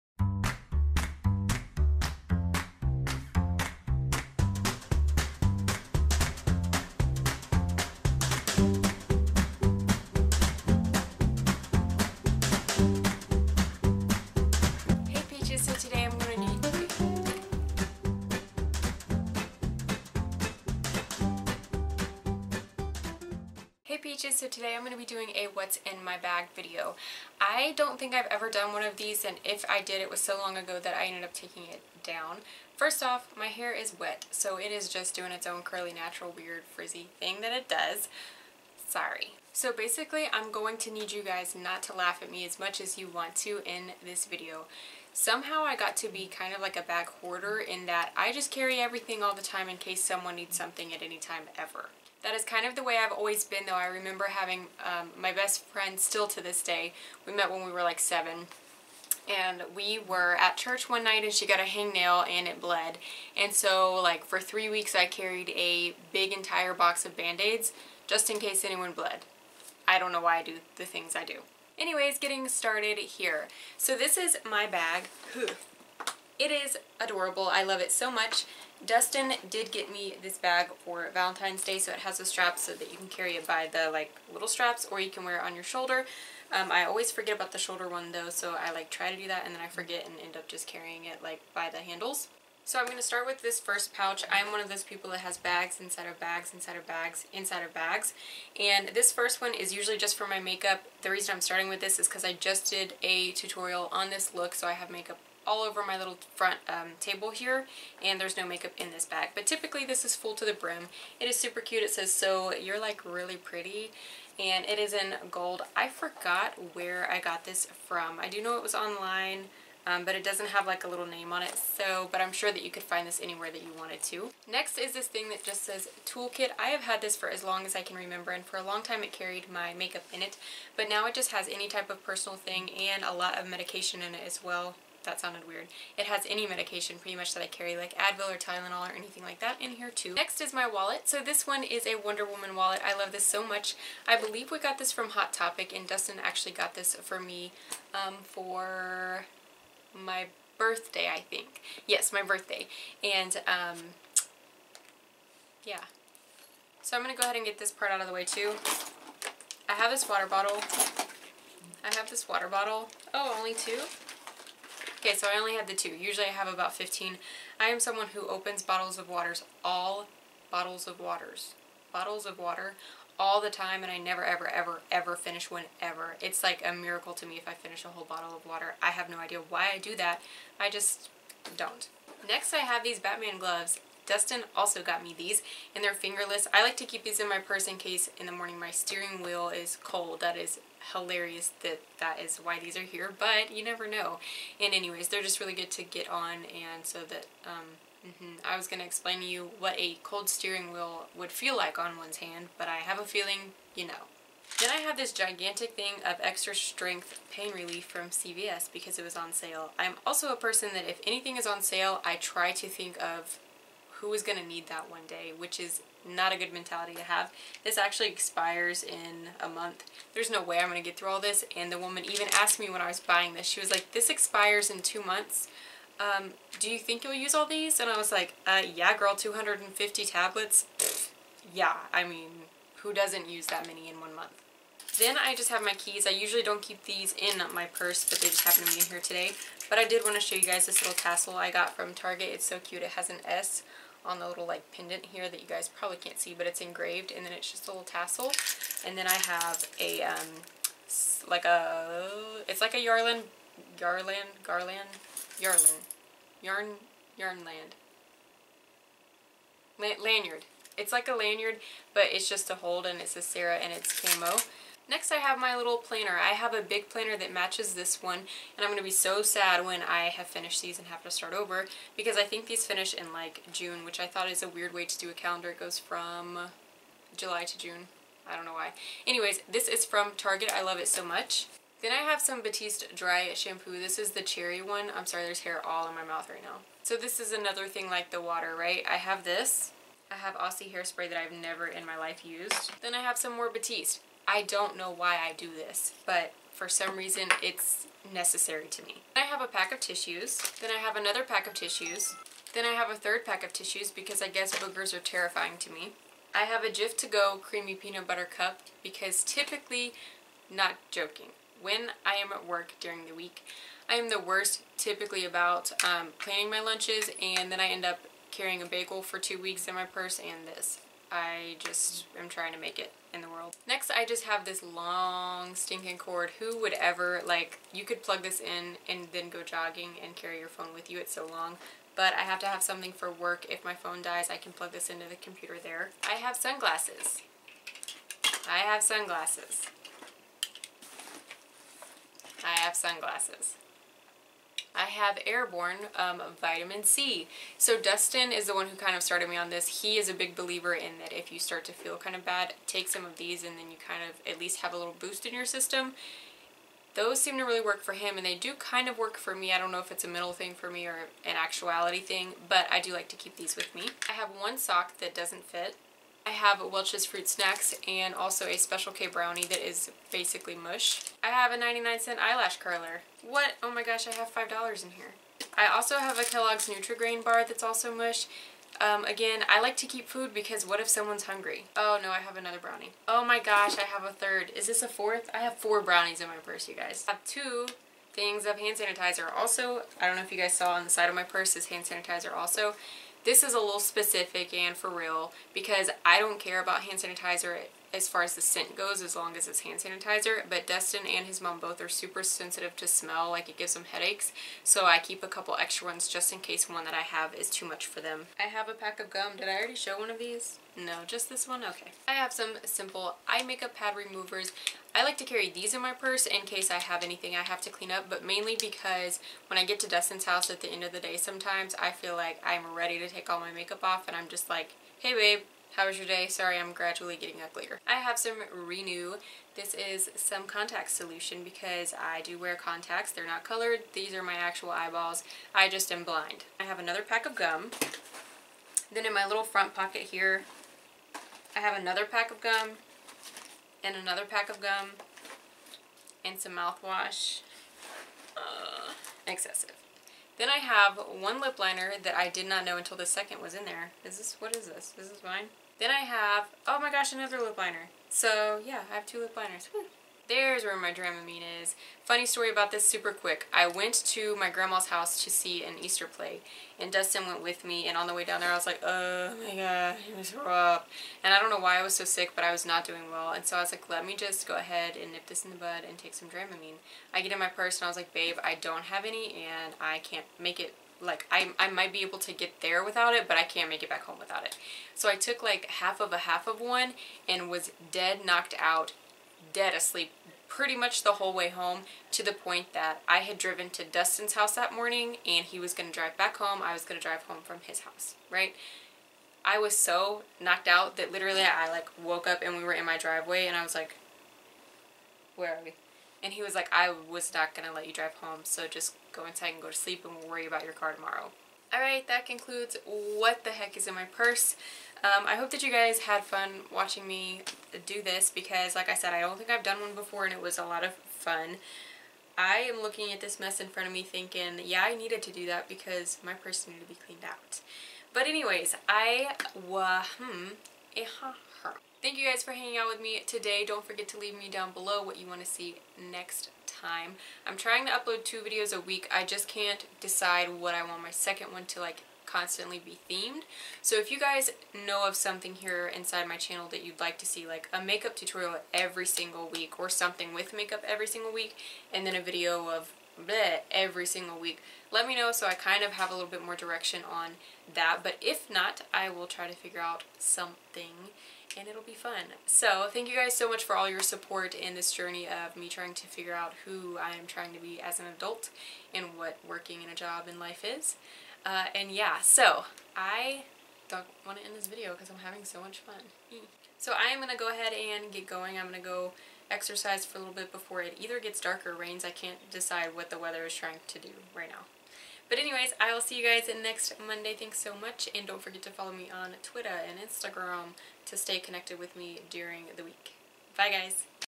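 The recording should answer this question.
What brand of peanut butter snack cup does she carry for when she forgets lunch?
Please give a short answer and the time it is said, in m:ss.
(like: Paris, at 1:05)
Jif, at 5:06.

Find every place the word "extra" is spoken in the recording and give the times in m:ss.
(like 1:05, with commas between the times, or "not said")
3:26, 6:45.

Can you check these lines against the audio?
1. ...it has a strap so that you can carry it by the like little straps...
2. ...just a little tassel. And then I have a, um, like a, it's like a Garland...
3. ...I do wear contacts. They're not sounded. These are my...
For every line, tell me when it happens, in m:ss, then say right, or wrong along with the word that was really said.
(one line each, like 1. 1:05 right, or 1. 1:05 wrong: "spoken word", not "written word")
1. 1:21 right
2. 4:07 wrong: "Yarlin", not "Garland"
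3. 7:11 wrong: "colored", not "sounded".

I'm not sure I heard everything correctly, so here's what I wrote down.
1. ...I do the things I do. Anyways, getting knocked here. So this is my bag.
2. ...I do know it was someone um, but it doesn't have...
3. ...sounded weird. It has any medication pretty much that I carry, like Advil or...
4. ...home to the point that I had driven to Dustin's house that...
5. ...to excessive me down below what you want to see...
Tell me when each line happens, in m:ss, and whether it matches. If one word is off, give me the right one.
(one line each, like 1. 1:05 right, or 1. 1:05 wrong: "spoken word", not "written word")
1. 1:10 wrong: "started", not "knocked"
2. 1:58 wrong: "online", not "someone"
3. 2:15 right
4. 8:11 right
5. 8:54 wrong: "leave", not "excessive".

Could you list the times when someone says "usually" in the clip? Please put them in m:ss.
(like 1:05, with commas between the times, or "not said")
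1:39, 2:45, 3:56.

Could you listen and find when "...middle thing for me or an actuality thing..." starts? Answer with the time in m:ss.
6:00.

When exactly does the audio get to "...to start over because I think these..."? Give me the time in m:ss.
4:31.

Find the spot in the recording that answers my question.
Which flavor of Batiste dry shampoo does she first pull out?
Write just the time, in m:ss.
4:44.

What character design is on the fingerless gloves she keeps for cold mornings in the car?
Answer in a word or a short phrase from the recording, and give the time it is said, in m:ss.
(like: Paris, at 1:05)
Batman, at 3:02.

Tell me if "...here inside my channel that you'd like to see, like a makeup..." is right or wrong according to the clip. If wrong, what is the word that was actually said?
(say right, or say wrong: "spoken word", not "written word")
right.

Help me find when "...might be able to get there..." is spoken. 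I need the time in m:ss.
8:01.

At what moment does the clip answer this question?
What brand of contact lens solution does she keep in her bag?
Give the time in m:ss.
7:08.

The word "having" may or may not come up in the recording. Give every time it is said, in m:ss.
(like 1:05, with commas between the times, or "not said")
0:54, 9:35.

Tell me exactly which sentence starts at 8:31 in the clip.
Alright, that concludes what the heck is in my purse.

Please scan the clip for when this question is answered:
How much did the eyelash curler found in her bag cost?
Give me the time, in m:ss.
6:11.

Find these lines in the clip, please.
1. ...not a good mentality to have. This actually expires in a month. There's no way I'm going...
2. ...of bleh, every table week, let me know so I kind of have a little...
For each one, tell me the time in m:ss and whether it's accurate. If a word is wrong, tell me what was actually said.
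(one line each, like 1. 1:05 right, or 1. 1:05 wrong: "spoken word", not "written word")
1. 3:36 right
2. 9:12 wrong: "single", not "table".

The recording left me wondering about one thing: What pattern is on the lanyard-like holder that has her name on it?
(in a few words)
camo.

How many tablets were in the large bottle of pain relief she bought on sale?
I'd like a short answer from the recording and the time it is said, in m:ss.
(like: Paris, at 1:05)
250, at 3:49.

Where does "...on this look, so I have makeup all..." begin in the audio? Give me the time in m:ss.
1:43.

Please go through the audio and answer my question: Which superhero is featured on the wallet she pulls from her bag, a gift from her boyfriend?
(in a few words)
Wonder Woman.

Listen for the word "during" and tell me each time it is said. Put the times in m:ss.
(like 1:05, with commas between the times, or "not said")
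5:12, 9:52.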